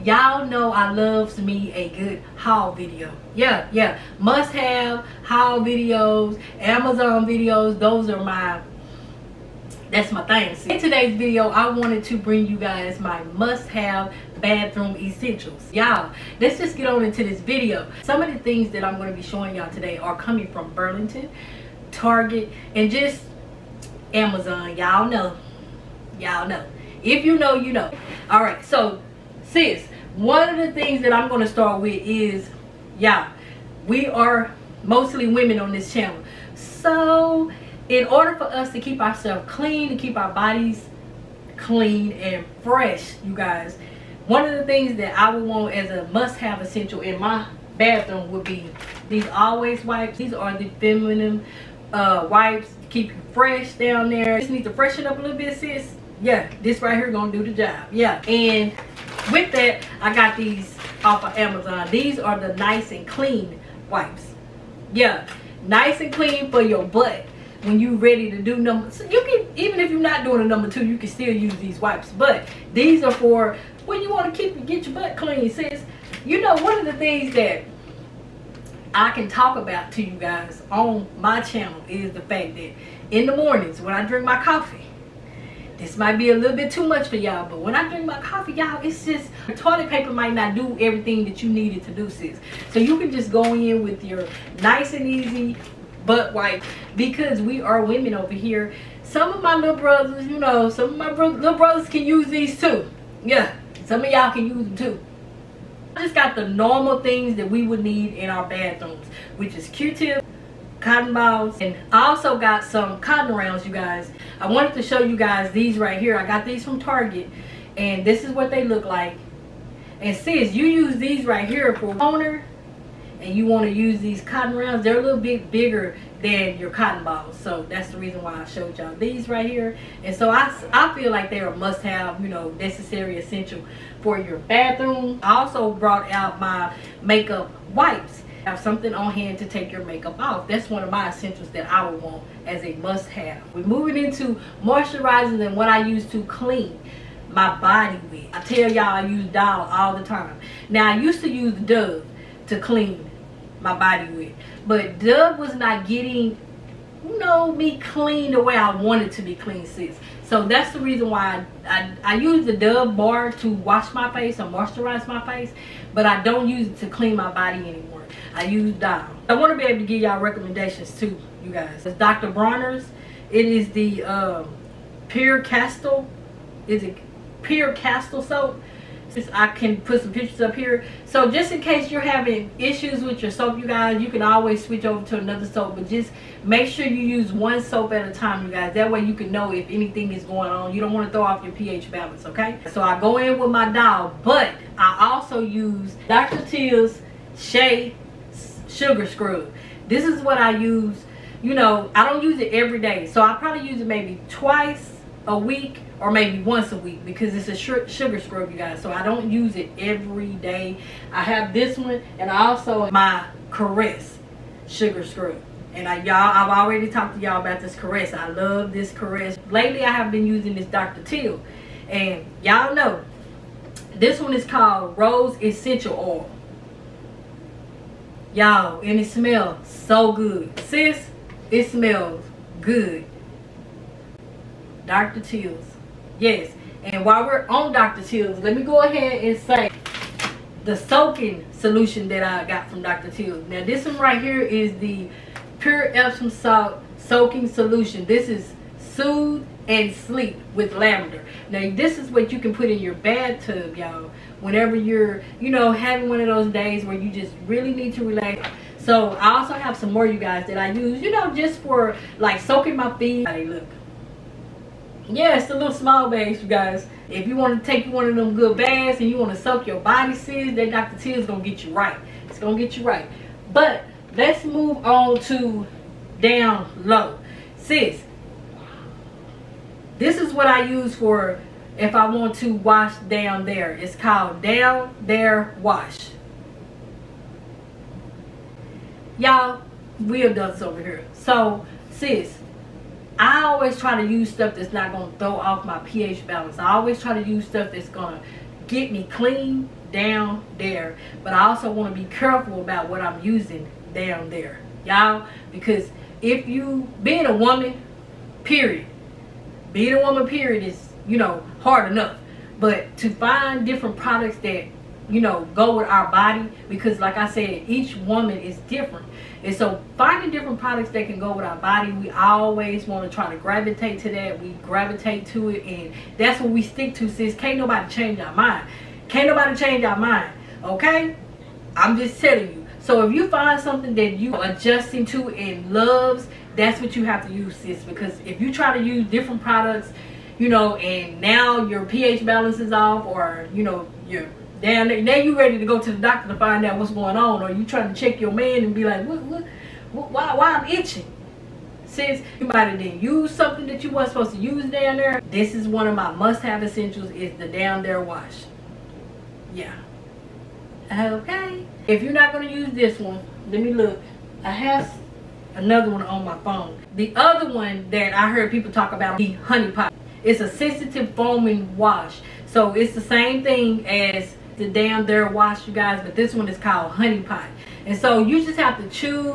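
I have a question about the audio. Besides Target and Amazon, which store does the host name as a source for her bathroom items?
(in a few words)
Burlington.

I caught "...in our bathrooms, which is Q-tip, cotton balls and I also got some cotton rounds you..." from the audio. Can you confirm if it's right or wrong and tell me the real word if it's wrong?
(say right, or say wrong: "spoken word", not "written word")
right.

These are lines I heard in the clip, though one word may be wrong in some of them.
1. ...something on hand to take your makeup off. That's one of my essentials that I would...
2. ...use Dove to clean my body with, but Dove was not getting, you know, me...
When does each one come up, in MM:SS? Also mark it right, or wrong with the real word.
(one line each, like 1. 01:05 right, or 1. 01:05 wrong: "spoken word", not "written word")
1. 02:18 right
2. 02:31 right.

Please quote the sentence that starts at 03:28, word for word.
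So I don't use it every day.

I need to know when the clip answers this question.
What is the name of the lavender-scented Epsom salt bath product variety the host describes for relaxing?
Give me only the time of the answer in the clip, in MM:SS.
04:08.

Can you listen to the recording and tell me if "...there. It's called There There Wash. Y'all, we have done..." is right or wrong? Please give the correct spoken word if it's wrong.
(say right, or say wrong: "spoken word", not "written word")
wrong: "Down", not "There".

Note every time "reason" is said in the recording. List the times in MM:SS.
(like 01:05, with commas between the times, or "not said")
02:07, 02:40.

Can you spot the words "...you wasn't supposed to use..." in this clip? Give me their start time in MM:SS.
05:53.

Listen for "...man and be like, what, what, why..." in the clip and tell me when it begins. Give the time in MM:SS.
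05:48.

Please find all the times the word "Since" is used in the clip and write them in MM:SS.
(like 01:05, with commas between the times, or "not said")
02:59, 05:51.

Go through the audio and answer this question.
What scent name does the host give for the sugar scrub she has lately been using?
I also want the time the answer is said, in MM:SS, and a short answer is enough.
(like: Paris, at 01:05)
Rose Essential Oil, at 03:44.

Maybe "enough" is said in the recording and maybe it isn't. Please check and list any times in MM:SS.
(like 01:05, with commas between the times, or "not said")
05:11.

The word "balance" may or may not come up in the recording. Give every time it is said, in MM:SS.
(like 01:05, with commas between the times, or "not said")
03:11, 04:56, 05:42.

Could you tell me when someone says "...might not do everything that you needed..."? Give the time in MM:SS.
01:30.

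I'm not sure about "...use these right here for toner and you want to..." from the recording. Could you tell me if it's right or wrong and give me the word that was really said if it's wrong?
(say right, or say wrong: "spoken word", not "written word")
right.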